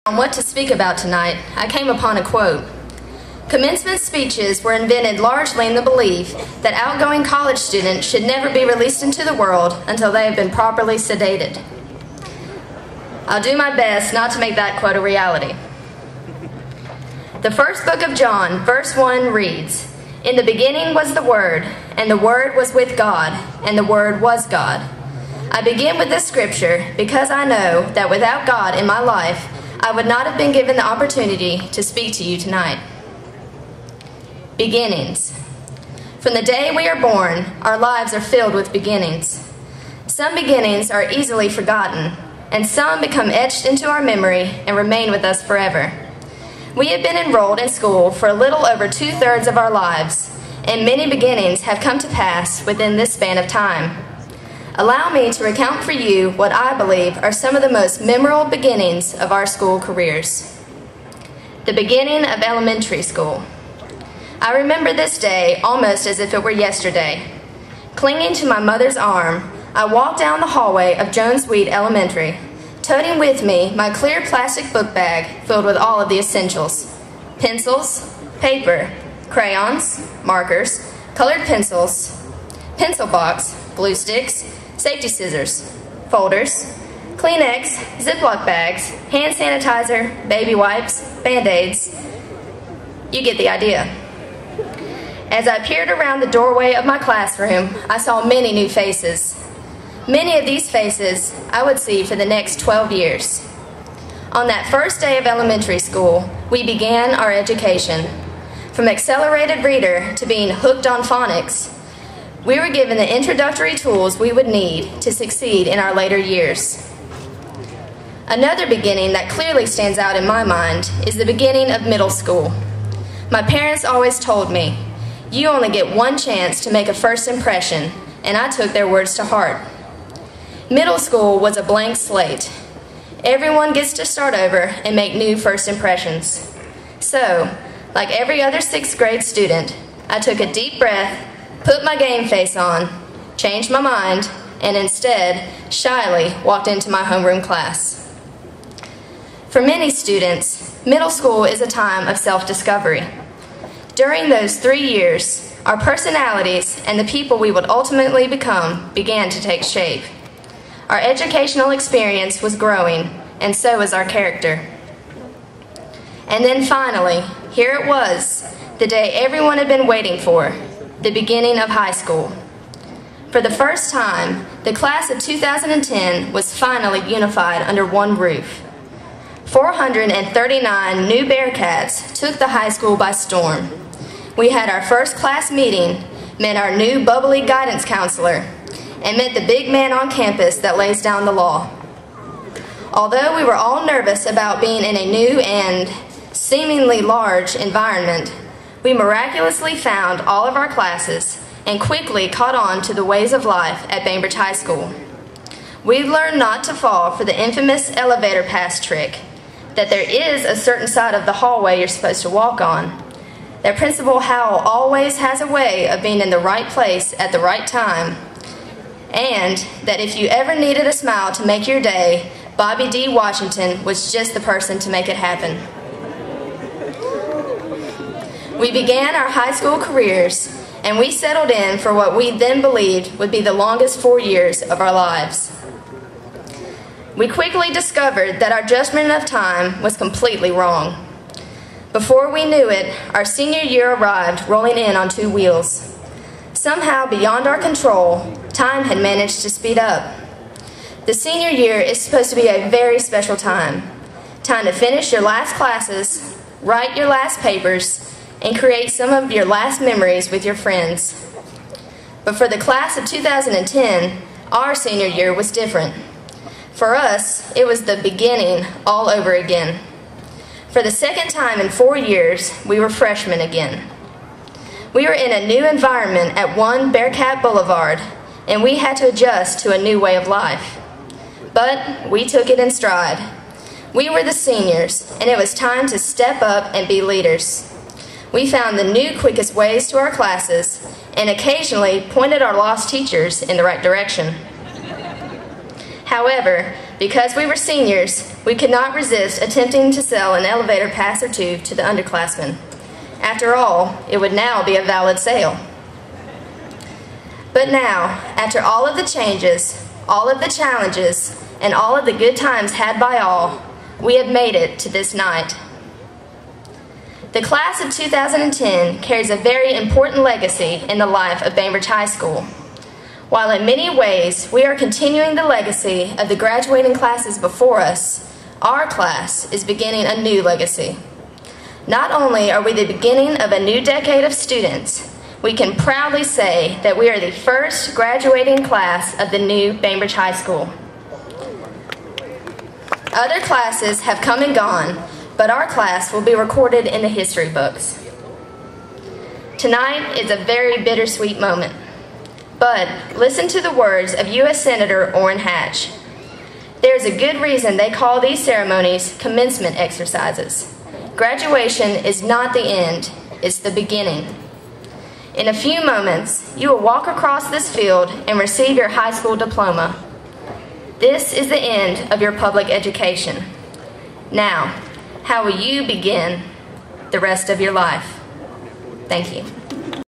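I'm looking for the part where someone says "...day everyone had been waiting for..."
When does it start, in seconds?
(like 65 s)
168 s.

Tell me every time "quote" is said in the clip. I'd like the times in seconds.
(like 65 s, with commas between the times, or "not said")
2 s, 14 s.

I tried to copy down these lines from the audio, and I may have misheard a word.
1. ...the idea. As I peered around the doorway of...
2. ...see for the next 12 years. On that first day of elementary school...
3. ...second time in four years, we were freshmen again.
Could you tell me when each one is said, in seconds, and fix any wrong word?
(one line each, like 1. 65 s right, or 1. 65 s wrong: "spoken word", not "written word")
1. 93 s right
2. 101 s right
3. 270 s right.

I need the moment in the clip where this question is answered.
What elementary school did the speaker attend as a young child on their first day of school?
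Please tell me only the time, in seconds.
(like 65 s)
71 s.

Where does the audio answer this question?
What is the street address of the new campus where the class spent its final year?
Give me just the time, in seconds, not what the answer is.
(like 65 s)
276 s.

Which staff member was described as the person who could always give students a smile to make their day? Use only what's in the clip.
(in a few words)
Bobby D. Washington.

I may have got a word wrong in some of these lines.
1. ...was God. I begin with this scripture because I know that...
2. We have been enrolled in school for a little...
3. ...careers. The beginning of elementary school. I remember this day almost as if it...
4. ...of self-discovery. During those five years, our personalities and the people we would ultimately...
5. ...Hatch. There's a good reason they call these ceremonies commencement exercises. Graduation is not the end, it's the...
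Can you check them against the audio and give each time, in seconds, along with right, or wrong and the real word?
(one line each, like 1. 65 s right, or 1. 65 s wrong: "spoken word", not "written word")
1. 24 s right
2. 46 s right
3. 59 s right
4. 152 s wrong: "three", not "five"
5. 355 s right.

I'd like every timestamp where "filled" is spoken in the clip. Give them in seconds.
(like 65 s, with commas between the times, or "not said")
38 s, 75 s.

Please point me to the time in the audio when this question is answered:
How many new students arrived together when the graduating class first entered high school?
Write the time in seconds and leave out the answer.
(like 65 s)
179 s.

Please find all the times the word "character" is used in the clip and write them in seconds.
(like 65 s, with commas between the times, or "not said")
164 s.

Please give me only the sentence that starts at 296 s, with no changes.
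However, because we were seniors, we could not resist attempting to sell an elevator pass or two to the underclassmen.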